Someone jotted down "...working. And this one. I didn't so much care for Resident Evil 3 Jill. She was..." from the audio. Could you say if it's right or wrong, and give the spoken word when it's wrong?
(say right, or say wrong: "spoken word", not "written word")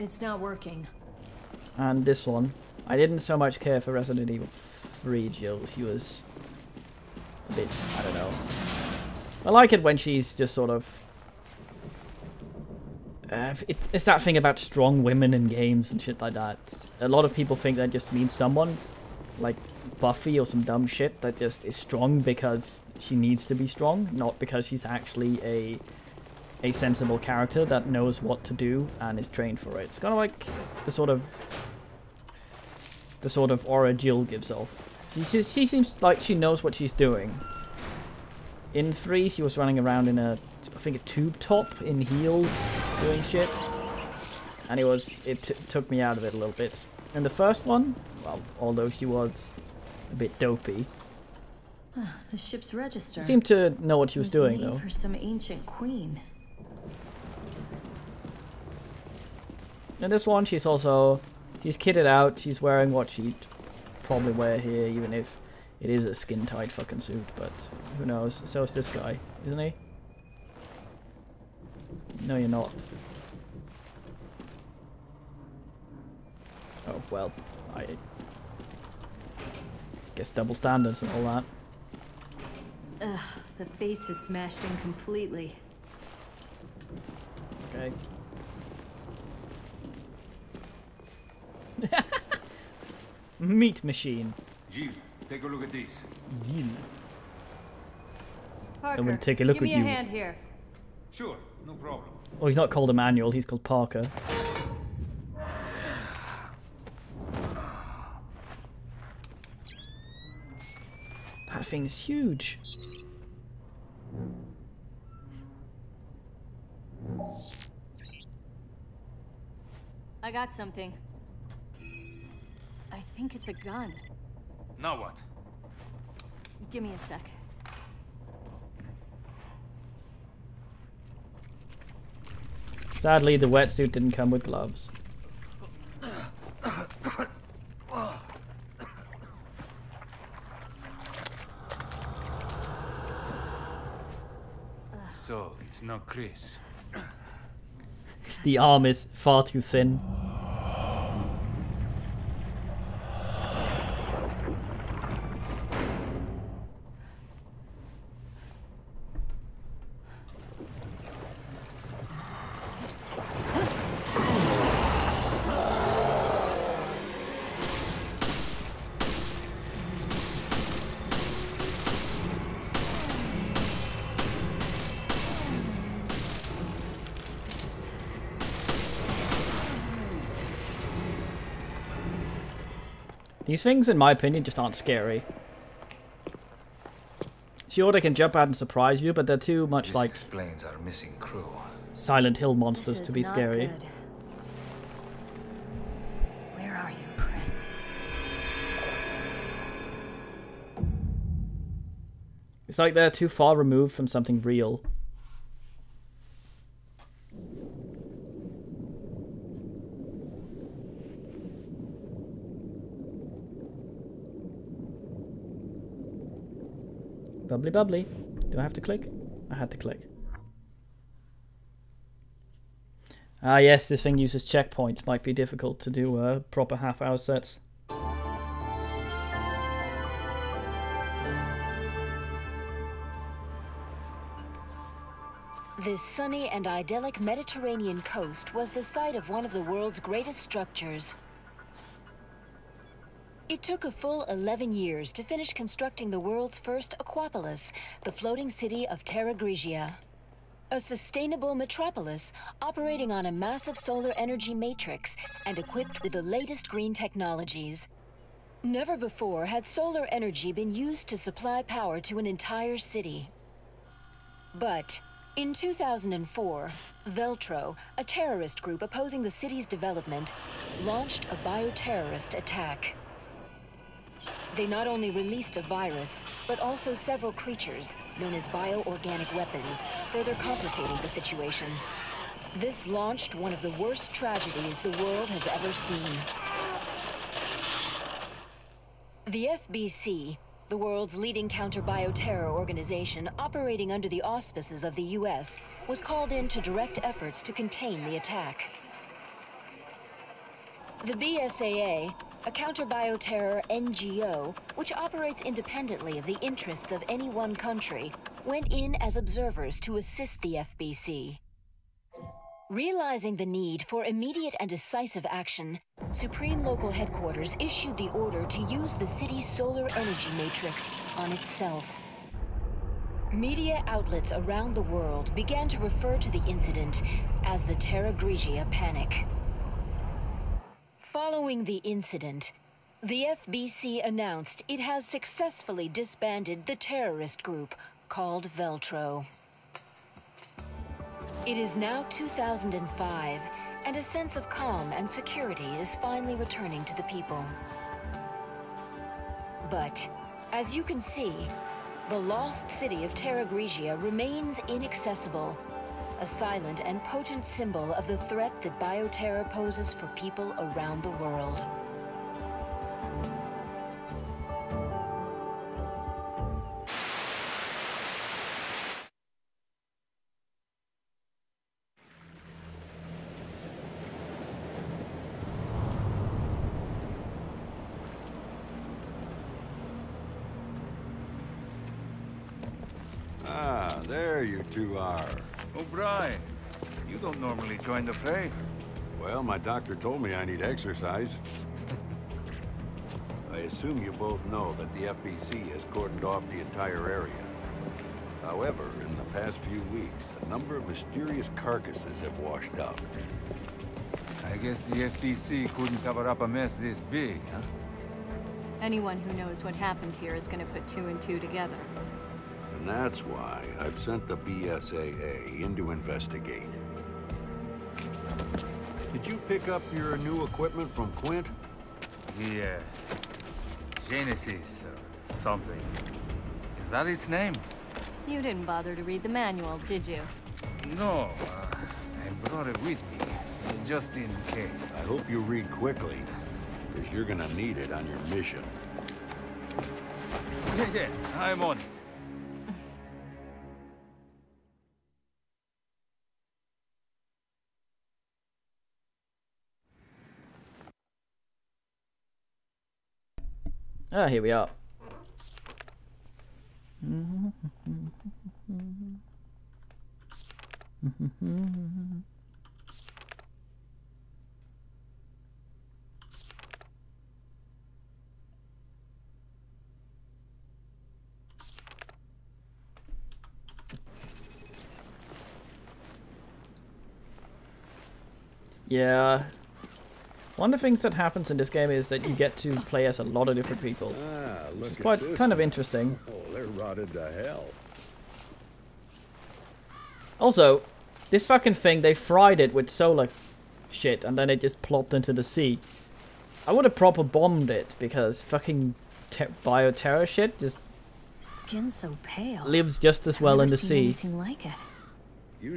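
right.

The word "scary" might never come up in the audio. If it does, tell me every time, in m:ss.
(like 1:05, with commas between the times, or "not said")
3:04, 3:13.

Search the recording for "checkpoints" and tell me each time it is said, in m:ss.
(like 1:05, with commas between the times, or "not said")
3:44.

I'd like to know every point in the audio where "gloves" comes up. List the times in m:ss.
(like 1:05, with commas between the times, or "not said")
2:14.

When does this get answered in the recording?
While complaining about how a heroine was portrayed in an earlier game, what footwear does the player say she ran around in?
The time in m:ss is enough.
0:42.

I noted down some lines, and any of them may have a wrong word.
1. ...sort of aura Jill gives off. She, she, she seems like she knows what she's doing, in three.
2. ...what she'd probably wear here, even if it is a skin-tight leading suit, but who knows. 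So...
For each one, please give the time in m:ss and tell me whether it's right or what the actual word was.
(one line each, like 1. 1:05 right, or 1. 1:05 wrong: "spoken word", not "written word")
1. 0:33 right
2. 1:02 wrong: "fucking", not "leading".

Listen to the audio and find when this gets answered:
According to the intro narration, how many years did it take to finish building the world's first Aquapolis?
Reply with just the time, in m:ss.
4:04.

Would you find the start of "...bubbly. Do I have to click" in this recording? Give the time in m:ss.
3:37.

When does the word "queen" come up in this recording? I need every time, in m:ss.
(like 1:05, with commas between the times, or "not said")
0:55.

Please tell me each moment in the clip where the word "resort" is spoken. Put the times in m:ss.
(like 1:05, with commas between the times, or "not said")
not said.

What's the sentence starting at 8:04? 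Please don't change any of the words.
Ah, it's quite kind of interesting.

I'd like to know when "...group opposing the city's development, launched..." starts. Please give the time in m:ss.
4:28.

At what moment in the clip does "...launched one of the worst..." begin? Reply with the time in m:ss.
4:42.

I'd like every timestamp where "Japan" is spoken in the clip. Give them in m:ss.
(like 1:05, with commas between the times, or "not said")
not said.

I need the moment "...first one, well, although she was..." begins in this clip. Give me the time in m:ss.
0:47.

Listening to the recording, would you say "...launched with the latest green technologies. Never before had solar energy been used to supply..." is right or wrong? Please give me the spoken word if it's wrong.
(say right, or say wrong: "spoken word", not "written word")
wrong: "equipped", not "launched".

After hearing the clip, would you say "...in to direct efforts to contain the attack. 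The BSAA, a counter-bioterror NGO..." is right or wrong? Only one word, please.
right.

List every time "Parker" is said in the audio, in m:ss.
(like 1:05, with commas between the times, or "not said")
1:38, 1:43.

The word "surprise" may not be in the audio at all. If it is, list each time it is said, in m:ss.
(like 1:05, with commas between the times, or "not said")
3:08.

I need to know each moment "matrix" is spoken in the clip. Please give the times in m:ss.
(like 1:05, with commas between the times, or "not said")
4:14, 5:20.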